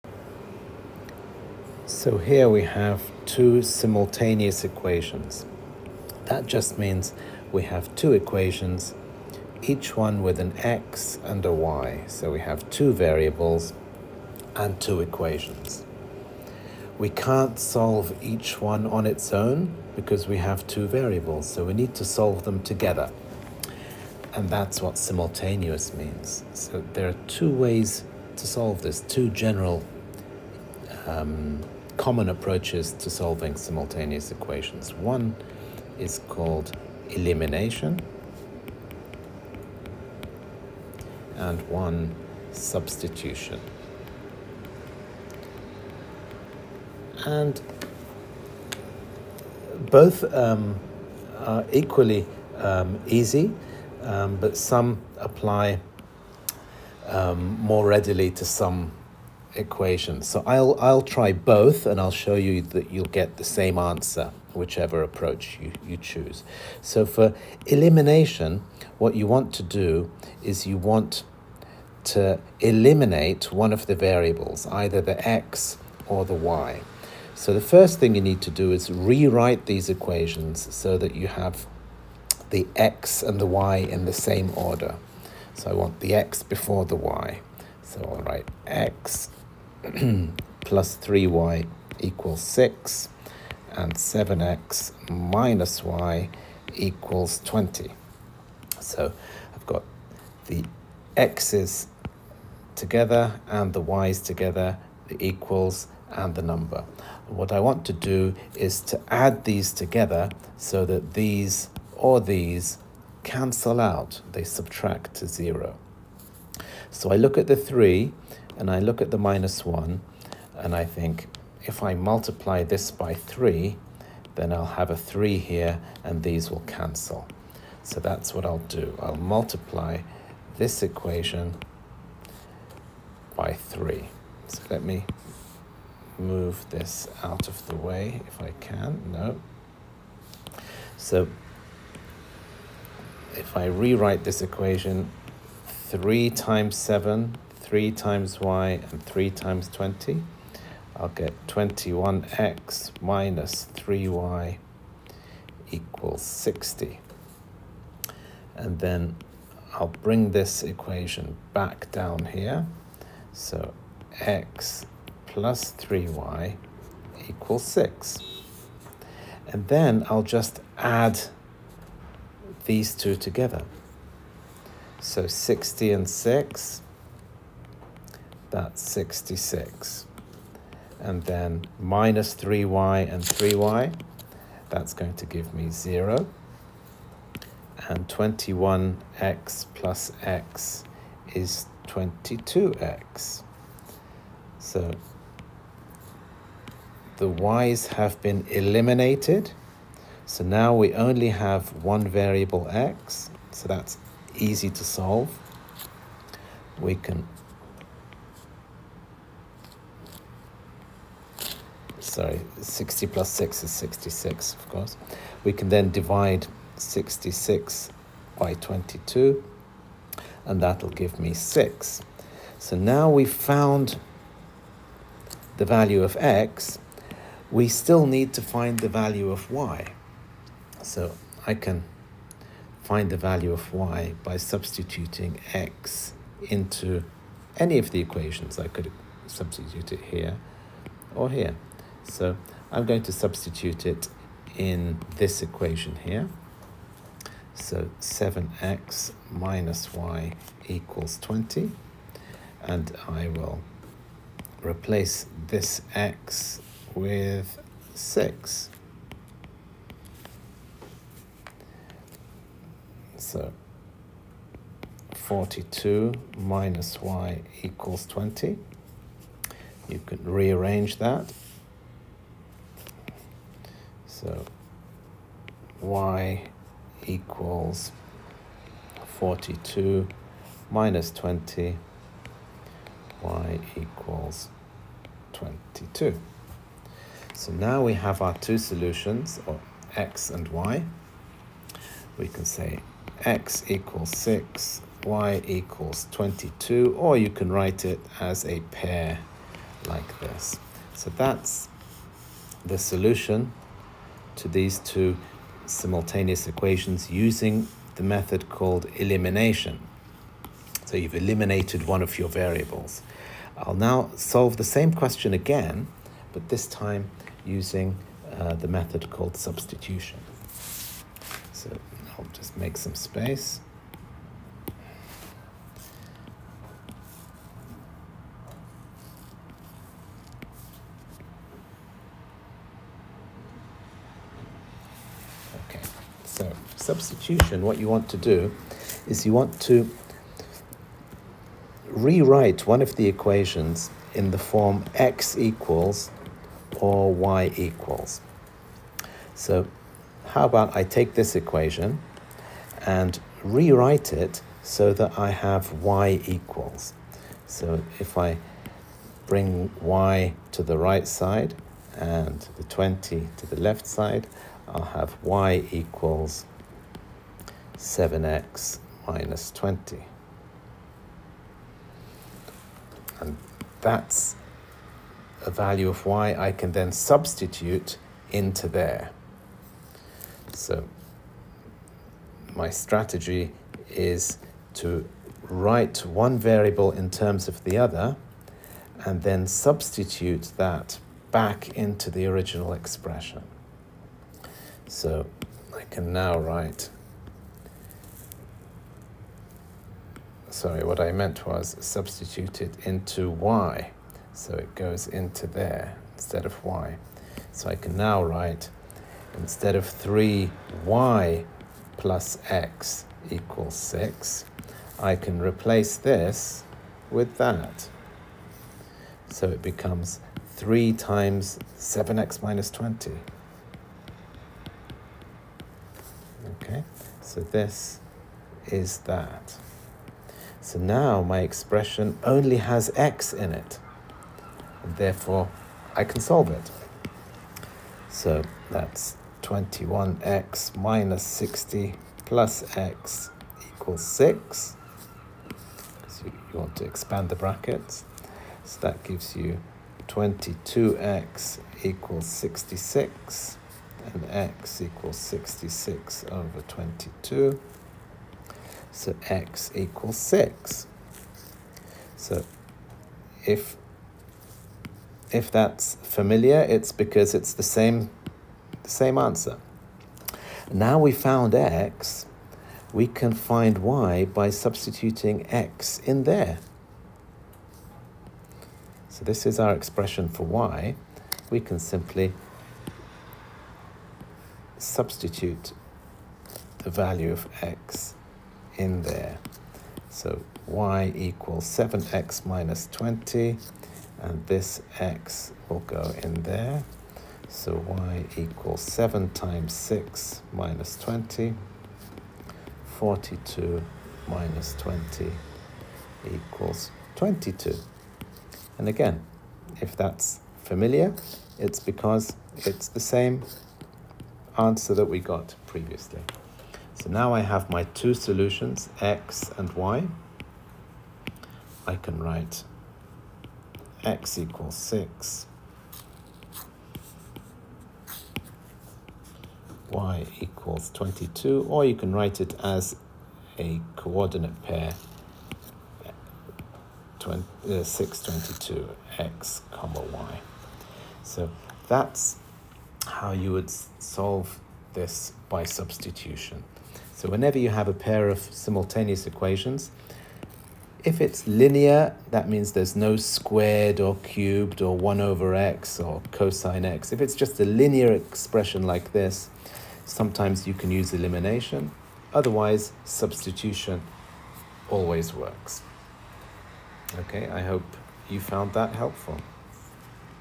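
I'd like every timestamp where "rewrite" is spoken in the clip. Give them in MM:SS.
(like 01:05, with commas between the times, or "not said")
01:18, 02:23, 05:41, 05:53.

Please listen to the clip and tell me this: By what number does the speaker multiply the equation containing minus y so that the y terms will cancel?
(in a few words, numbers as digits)
3.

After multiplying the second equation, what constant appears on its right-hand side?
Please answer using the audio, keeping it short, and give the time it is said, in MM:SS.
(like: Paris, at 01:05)
60, at 02:33.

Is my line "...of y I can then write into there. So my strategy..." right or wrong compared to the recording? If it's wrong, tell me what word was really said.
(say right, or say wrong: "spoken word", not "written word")
wrong: "substitute", not "write".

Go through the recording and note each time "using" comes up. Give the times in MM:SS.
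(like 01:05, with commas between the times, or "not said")
05:07, 05:17.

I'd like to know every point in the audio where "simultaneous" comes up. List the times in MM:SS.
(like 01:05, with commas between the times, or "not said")
00:03, 00:24, 00:33, 05:05, 09:08.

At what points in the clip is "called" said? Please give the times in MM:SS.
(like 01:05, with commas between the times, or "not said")
00:36, 05:08, 05:19.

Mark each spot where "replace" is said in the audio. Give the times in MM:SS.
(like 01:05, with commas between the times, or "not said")
04:14, 06:55.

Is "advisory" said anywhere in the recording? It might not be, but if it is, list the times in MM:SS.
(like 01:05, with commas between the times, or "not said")
not said.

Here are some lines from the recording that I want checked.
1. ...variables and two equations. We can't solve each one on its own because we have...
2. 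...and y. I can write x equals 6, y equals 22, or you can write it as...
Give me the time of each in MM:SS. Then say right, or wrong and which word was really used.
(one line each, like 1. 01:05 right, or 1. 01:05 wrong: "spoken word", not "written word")
1. 00:12 right
2. 08:39 right.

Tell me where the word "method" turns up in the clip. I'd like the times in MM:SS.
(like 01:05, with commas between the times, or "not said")
05:08, 05:18.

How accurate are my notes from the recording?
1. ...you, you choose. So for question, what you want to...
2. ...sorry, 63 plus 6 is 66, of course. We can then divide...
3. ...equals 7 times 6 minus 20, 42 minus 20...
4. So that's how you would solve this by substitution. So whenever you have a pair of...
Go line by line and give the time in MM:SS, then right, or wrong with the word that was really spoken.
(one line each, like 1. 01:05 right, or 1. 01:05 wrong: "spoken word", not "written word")
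1. 01:05 wrong: "elimination", not "question"
2. 03:32 wrong: "60", not "63"
3. 08:18 right
4. 09:01 right.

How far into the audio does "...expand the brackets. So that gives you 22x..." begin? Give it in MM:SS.
07:26.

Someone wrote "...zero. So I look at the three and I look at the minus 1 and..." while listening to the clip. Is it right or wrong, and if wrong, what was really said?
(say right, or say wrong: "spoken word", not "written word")
right.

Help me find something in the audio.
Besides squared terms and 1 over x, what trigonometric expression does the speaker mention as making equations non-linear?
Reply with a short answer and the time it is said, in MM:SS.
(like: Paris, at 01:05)
cosine x, at 09:16.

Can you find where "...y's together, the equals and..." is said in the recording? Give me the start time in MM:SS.
01:43.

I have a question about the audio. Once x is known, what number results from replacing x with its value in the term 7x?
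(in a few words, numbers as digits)
42.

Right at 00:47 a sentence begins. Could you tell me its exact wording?
And both um, are equally um, easy, um, but some apply um, more readily to some equations.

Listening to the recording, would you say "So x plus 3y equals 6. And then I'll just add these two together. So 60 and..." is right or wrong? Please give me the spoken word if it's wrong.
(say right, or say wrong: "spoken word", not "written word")
right.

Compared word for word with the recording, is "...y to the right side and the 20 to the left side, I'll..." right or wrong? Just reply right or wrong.
right.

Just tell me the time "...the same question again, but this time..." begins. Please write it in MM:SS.
05:14.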